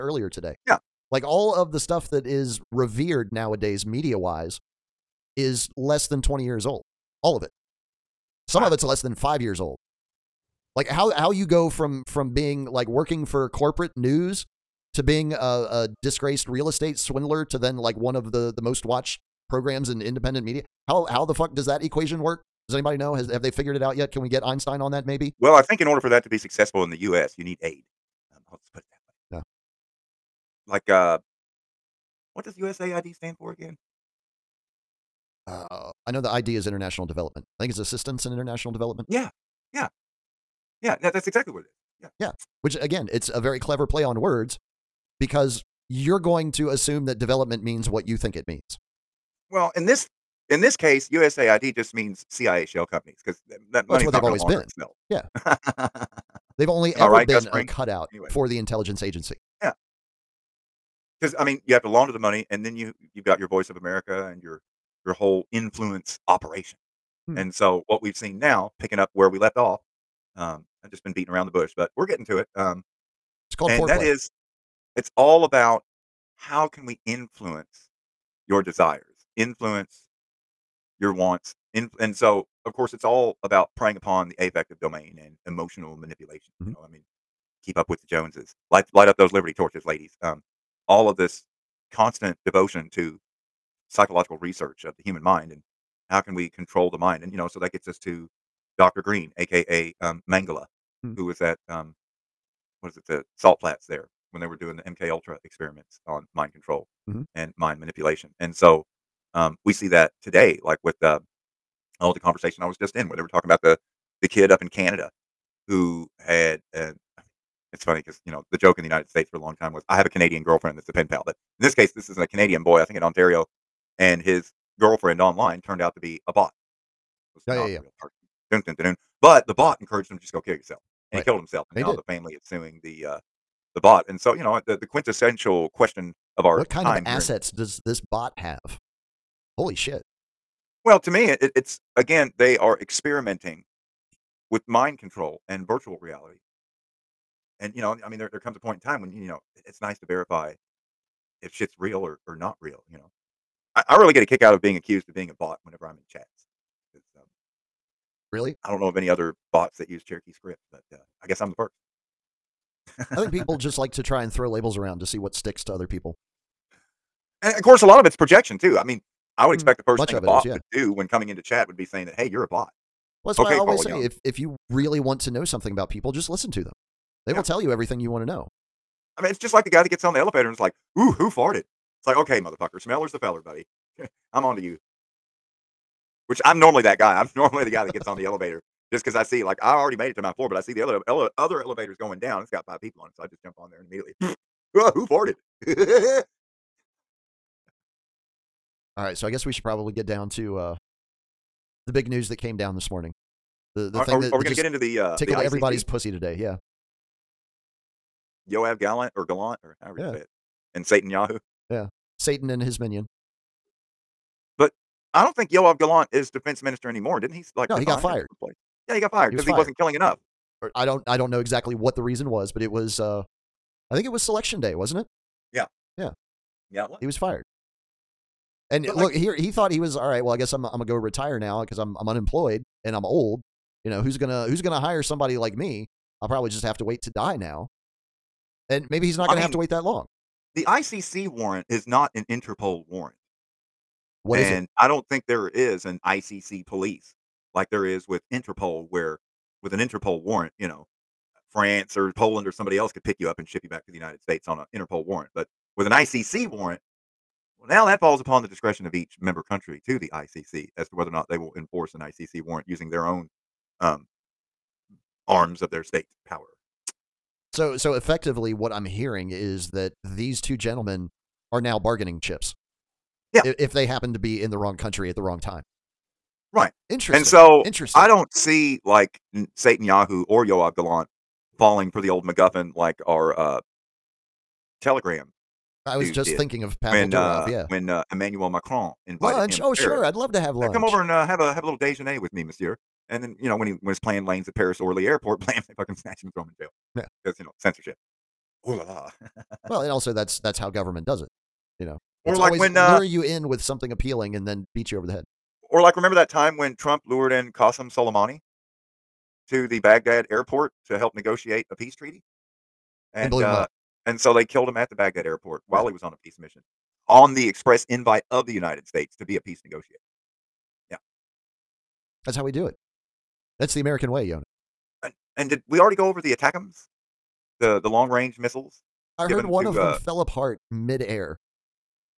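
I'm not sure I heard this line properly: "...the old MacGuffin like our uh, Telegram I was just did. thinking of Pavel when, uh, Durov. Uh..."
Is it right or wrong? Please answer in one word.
right.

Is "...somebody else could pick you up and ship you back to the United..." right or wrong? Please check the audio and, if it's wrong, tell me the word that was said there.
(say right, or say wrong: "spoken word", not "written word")
right.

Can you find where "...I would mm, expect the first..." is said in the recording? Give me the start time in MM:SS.
02:49.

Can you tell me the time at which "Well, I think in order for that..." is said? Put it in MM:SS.
00:25.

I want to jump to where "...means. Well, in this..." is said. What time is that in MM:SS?
00:48.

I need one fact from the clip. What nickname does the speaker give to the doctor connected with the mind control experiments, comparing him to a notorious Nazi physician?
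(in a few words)
Dr. Green.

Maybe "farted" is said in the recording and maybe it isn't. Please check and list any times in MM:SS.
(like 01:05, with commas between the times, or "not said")
03:01, 03:15.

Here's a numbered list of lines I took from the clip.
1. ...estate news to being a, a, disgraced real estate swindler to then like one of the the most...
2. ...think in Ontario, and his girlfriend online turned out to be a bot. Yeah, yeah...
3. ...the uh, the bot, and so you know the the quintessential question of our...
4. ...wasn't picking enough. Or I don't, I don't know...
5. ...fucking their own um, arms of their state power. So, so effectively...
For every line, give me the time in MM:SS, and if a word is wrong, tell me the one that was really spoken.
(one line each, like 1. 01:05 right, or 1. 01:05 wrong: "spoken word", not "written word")
1. 00:13 wrong: "corporate", not "estate"
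2. 02:02 right
3. 02:12 right
4. 03:39 wrong: "killing", not "picking"
5. 04:22 wrong: "using", not "fucking".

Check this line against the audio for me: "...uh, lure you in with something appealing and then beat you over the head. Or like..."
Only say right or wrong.
right.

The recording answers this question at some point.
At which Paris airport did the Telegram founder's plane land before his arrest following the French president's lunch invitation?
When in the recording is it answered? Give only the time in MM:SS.
04:54.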